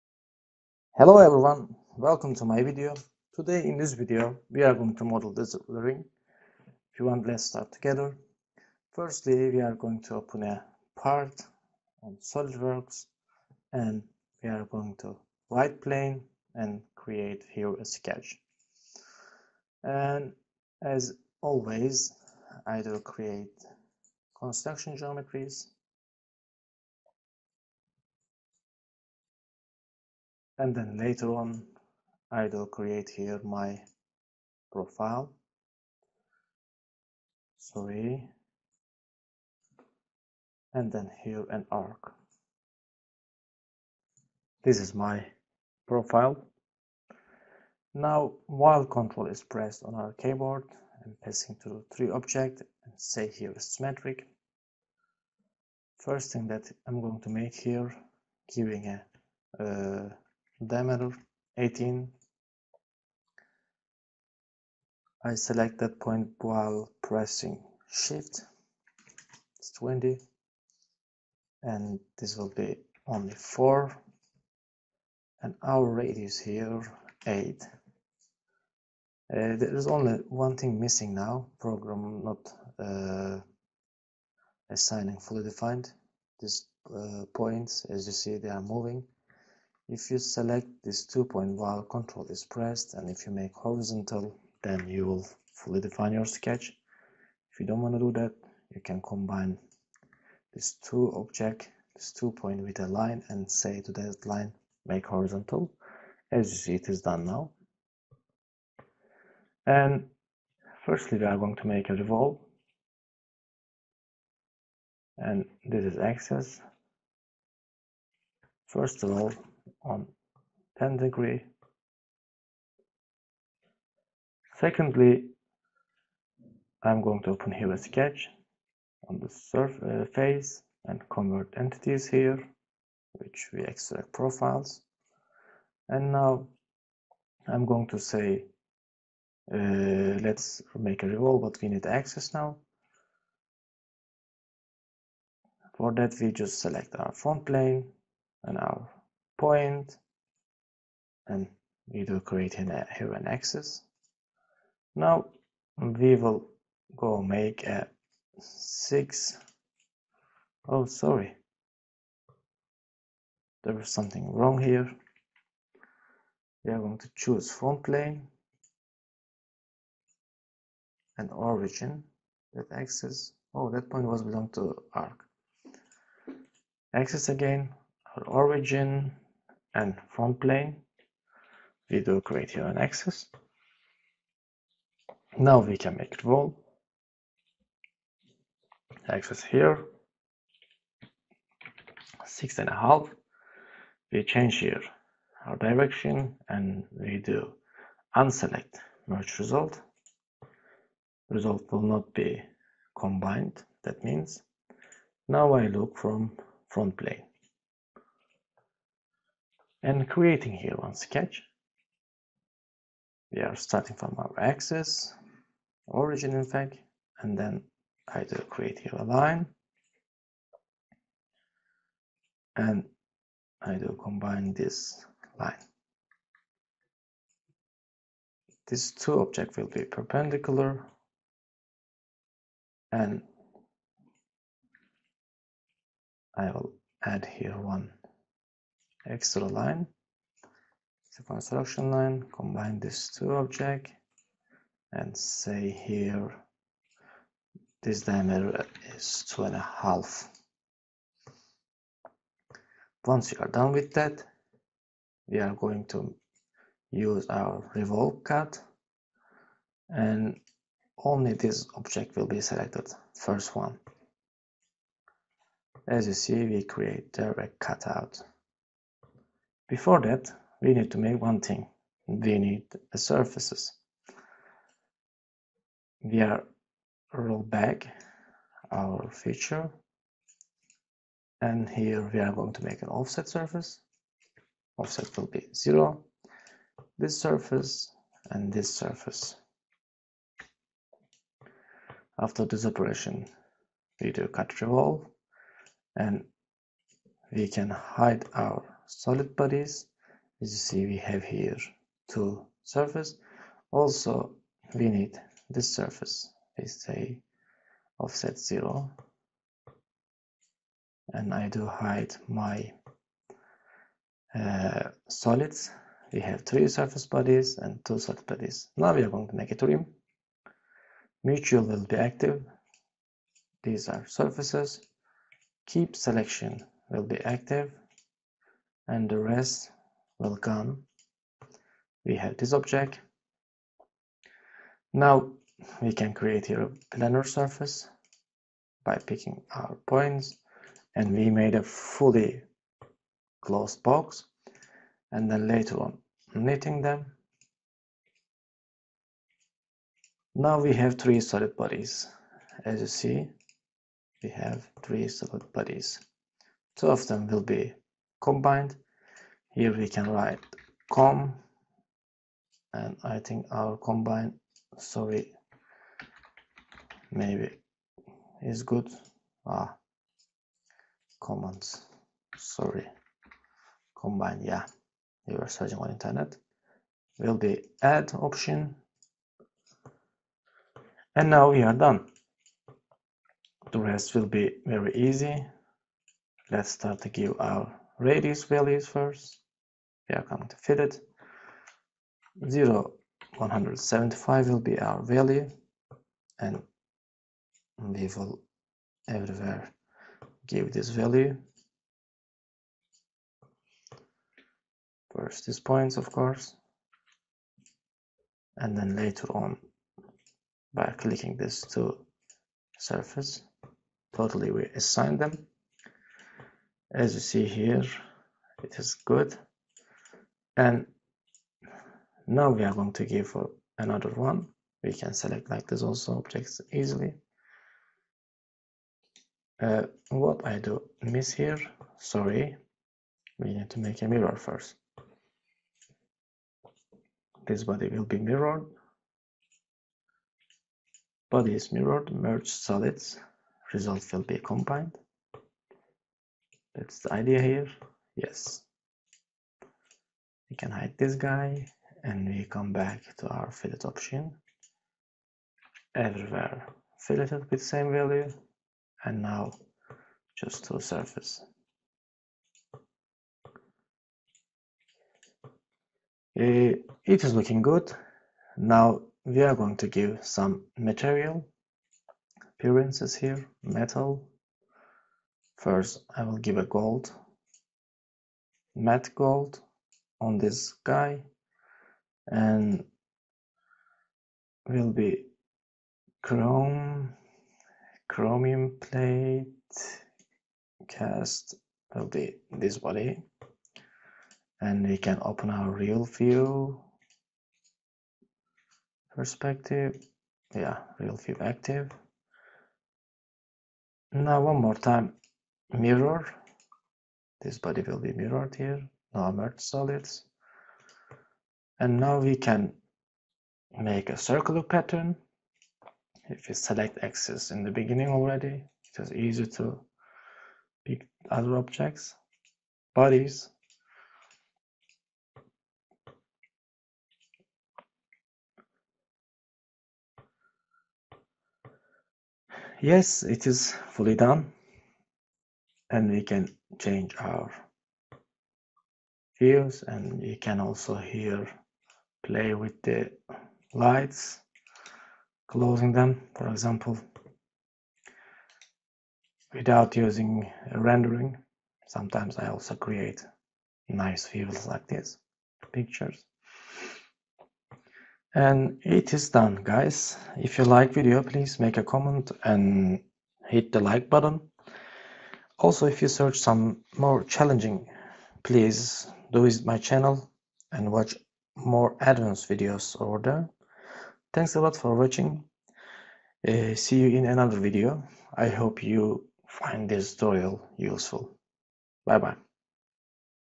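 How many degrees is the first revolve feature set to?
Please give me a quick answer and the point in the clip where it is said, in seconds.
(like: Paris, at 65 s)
10 degrees, at 120 s.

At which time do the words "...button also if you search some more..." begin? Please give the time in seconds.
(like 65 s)
564 s.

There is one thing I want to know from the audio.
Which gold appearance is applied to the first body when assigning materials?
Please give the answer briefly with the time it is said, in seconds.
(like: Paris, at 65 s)
Matte gold, at 478 s.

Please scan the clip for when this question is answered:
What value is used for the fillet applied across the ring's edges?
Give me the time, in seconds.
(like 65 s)
392 s.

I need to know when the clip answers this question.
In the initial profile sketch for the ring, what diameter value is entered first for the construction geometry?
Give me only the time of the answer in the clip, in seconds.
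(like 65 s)
61 s.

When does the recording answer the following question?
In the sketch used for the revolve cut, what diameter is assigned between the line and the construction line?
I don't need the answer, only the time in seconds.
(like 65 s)
249 s.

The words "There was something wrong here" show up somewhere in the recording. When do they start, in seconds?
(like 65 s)
163 s.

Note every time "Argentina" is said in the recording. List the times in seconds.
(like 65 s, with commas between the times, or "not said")
not said.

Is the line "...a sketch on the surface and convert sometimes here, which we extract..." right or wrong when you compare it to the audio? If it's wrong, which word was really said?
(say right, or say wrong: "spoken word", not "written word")
wrong: "entities", not "sometimes".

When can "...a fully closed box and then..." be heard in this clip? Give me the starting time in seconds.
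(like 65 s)
341 s.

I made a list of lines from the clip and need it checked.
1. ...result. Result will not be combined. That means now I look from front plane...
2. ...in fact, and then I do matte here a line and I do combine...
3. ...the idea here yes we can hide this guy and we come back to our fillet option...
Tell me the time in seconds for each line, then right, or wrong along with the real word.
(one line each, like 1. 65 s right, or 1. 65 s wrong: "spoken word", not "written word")
1. 199 s right
2. 216 s wrong: "create", not "matte"
3. 446 s right.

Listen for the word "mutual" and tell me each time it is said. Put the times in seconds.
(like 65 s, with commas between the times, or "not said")
321 s.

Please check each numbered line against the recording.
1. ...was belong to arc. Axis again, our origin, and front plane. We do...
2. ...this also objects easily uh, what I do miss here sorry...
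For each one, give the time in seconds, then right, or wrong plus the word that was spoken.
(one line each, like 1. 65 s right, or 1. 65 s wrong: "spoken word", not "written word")
1. 174 s right
2. 425 s right.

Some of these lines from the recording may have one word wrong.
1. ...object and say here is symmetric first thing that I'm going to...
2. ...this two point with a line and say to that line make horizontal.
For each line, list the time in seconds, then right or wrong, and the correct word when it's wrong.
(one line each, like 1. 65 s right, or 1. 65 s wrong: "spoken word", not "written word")
1. 52 s right
2. 101 s right.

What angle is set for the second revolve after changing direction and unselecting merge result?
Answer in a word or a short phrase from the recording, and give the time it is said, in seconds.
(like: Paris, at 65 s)
6.5, at 192 s.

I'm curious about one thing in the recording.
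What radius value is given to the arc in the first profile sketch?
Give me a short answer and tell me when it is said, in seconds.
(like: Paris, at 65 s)
8, at 75 s.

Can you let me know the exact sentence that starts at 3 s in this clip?
Today in this video we are going to model this ring.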